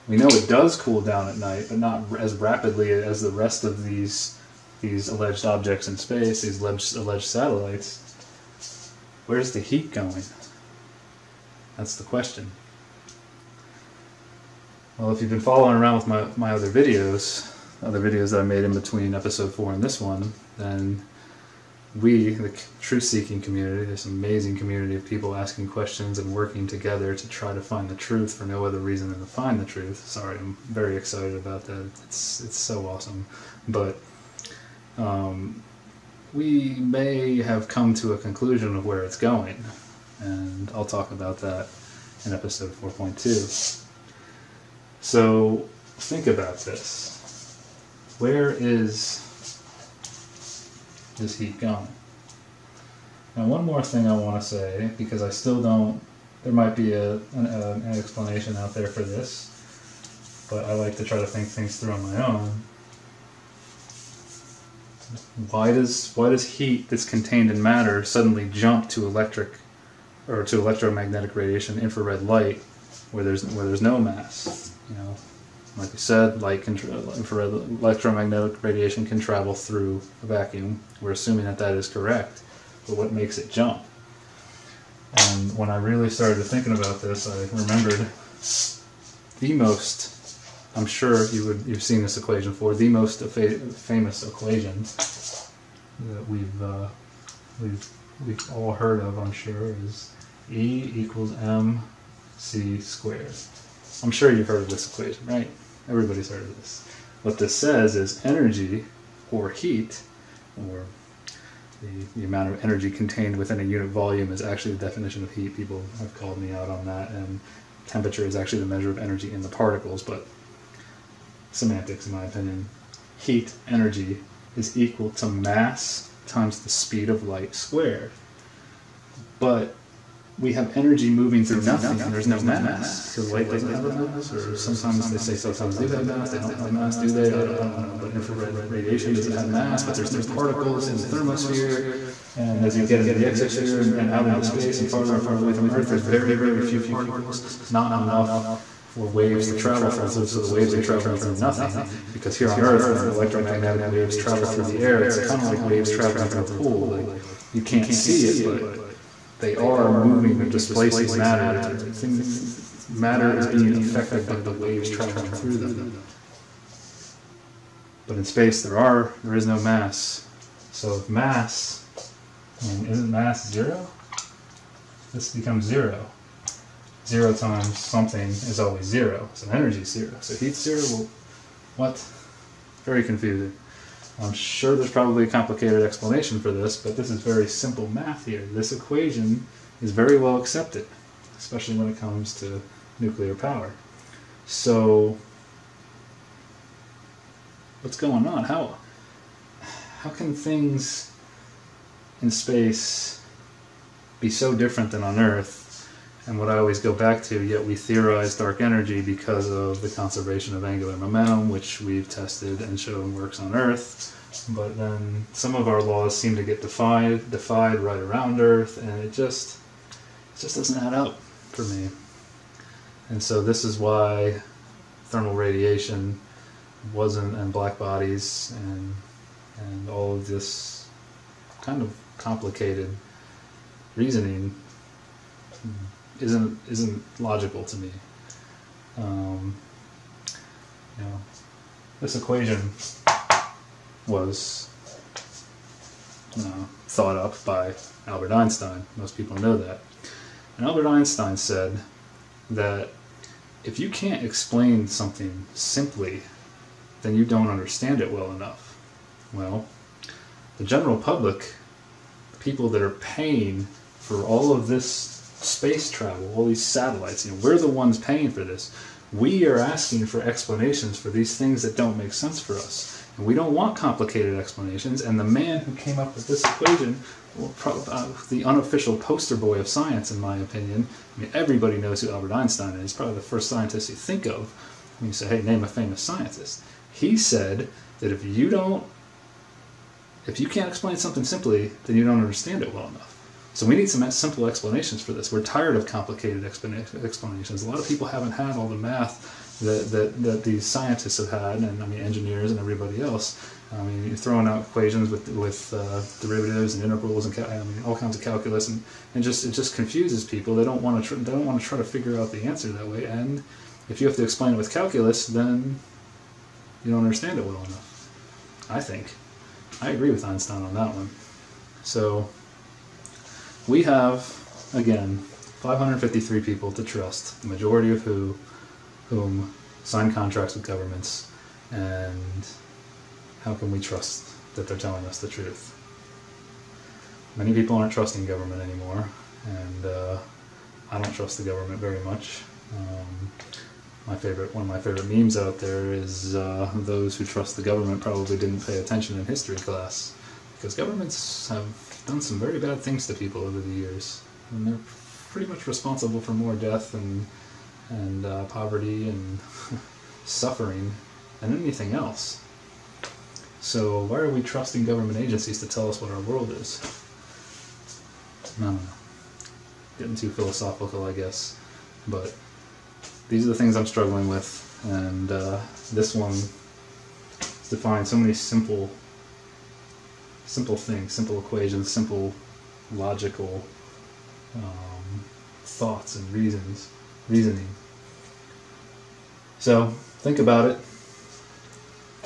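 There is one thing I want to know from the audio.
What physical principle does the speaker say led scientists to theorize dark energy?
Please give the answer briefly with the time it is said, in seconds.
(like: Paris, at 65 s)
conservation of angular momentum, at 209 s.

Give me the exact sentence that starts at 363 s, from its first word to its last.
So why are we trusting government agencies to tell us what our world is?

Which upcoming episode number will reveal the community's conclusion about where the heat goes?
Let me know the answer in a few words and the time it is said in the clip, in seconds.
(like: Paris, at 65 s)
4.2, at 42 s.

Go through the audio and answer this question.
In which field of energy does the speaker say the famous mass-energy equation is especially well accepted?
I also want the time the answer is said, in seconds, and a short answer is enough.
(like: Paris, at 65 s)
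nuclear power, at 192 s.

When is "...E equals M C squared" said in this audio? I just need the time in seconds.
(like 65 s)
100 s.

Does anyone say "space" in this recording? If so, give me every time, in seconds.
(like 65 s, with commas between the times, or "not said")
5 s, 144 s, 168 s, 202 s, 265 s.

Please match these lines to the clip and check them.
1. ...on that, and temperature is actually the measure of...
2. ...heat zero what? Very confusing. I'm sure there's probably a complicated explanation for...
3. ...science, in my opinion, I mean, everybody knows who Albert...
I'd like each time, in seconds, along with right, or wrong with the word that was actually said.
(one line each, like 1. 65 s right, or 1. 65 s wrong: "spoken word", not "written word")
1. 116 s right
2. 180 s right
3. 279 s right.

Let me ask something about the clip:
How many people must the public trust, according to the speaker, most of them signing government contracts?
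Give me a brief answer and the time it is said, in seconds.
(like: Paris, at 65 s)
553, at 325 s.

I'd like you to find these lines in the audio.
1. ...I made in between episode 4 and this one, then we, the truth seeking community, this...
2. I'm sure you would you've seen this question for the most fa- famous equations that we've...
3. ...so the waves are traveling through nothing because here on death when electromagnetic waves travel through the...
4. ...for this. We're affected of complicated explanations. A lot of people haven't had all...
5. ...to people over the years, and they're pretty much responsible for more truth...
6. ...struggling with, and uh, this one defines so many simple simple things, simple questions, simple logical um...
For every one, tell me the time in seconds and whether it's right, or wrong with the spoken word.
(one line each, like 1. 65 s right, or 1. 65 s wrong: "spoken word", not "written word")
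1. 18 s right
2. 90 s wrong: "equation", not "question"
3. 150 s wrong: "earth", not "death"
4. 295 s wrong: "tired", not "affected"
5. 353 s wrong: "death", not "truth"
6. 373 s wrong: "equations", not "questions".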